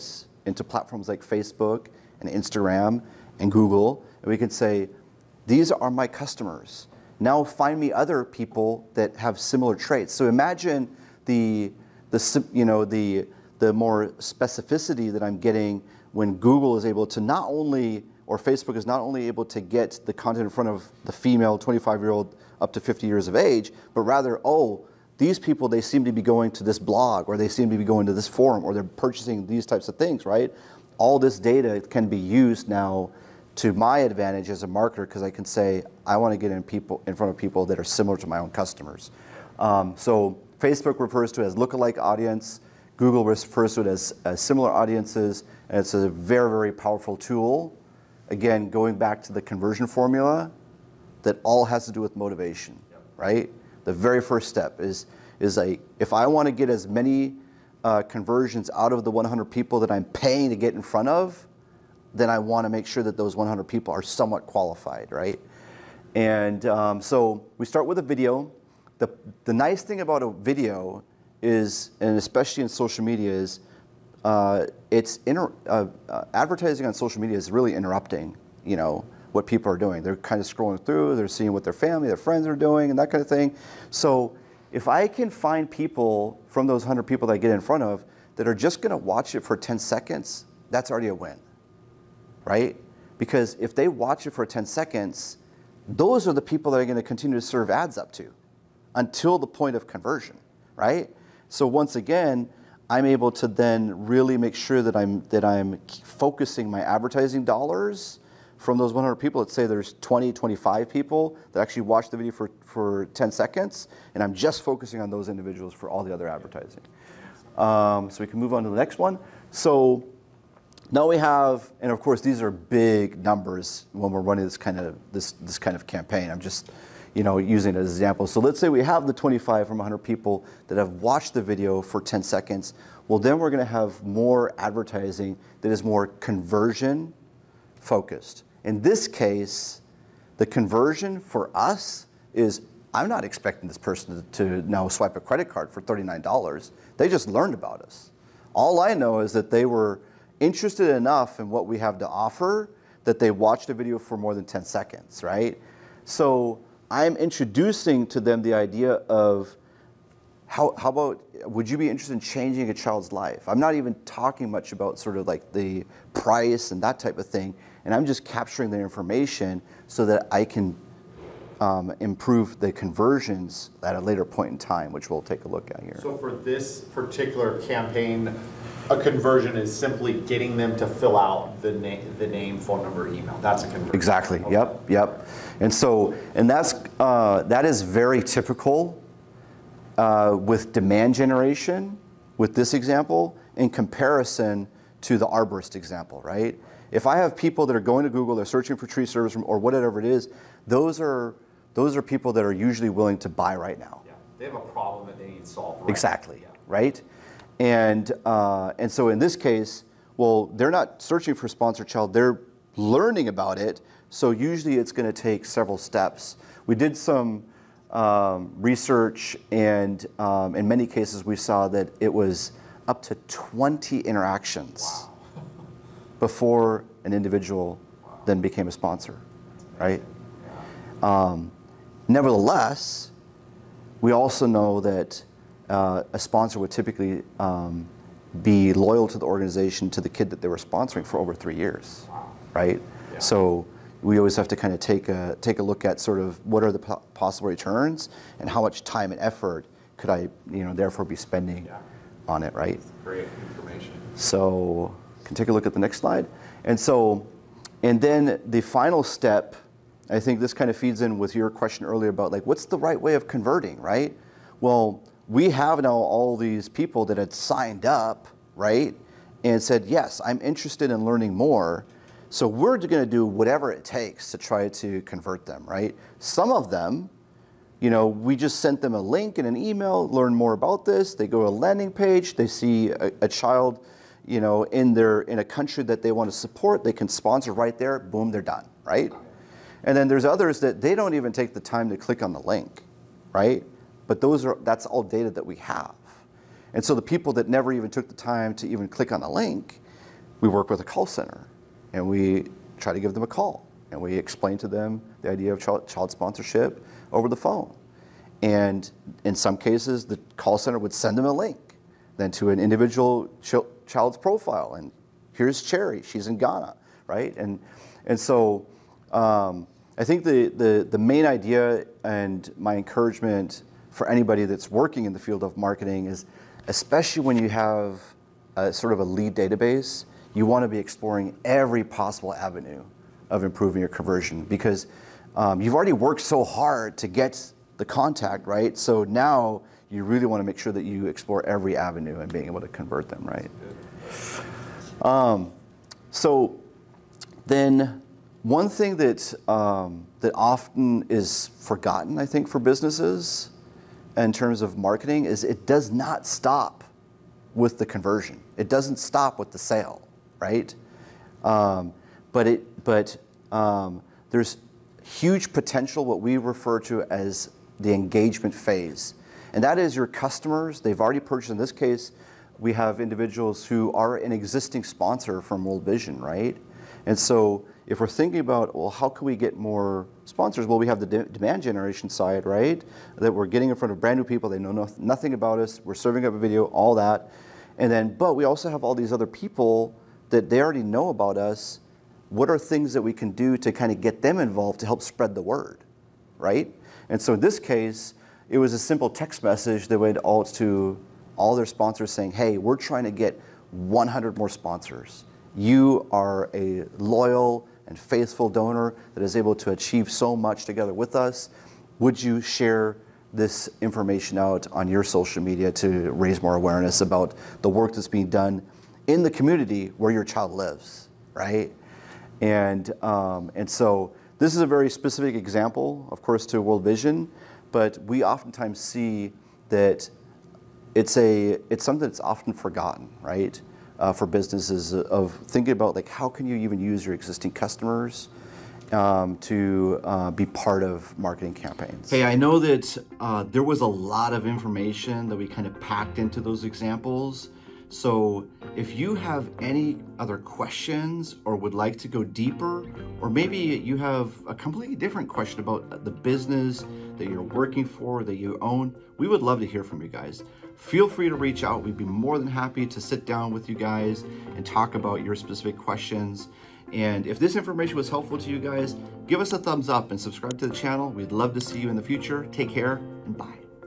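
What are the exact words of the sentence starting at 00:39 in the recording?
Um, so Facebook refers to it as lookalike audience.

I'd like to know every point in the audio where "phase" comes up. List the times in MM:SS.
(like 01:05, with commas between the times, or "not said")
06:08.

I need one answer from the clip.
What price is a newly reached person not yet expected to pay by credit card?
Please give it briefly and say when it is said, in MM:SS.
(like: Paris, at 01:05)
$39, at 02:25.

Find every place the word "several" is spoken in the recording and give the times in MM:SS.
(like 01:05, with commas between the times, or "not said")
03:35.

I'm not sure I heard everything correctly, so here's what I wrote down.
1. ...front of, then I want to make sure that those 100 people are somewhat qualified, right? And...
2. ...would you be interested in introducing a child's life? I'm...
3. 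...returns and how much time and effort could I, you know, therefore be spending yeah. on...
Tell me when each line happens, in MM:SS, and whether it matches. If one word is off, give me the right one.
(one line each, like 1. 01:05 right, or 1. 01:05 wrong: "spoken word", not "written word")
1. 01:00 right
2. 02:41 wrong: "changing", not "introducing"
3. 04:07 right.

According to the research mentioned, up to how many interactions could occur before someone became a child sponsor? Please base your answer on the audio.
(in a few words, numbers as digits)
20.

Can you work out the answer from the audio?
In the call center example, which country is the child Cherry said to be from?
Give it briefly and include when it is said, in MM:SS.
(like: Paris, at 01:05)
Ghana, at 05:16.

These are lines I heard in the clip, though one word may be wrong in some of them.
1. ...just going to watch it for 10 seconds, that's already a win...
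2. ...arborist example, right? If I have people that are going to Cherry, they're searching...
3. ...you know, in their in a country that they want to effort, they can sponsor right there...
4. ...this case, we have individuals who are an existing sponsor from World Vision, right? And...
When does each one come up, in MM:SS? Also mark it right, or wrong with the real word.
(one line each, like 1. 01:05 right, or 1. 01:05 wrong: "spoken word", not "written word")
1. 01:28 right
2. 03:15 wrong: "Google", not "Cherry"
3. 04:44 wrong: "support", not "effort"
4. 06:11 right.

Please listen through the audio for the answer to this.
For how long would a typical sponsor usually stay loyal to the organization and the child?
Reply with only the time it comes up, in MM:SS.
04:01.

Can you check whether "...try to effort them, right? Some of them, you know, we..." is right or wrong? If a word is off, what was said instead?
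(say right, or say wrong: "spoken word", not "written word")
wrong: "convert", not "effort".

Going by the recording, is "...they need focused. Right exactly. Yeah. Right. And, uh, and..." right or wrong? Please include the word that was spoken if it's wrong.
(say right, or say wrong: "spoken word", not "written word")
wrong: "solved", not "focused".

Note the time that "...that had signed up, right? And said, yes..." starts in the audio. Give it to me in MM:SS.
04:27.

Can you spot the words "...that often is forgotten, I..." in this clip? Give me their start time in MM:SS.
05:50.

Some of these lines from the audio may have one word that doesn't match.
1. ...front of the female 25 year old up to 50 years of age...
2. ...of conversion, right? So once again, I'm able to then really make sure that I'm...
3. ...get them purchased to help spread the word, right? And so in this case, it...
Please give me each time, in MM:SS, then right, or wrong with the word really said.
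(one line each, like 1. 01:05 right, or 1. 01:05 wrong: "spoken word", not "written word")
1. 00:20 right
2. 01:39 right
3. 06:33 wrong: "involved", not "purchased".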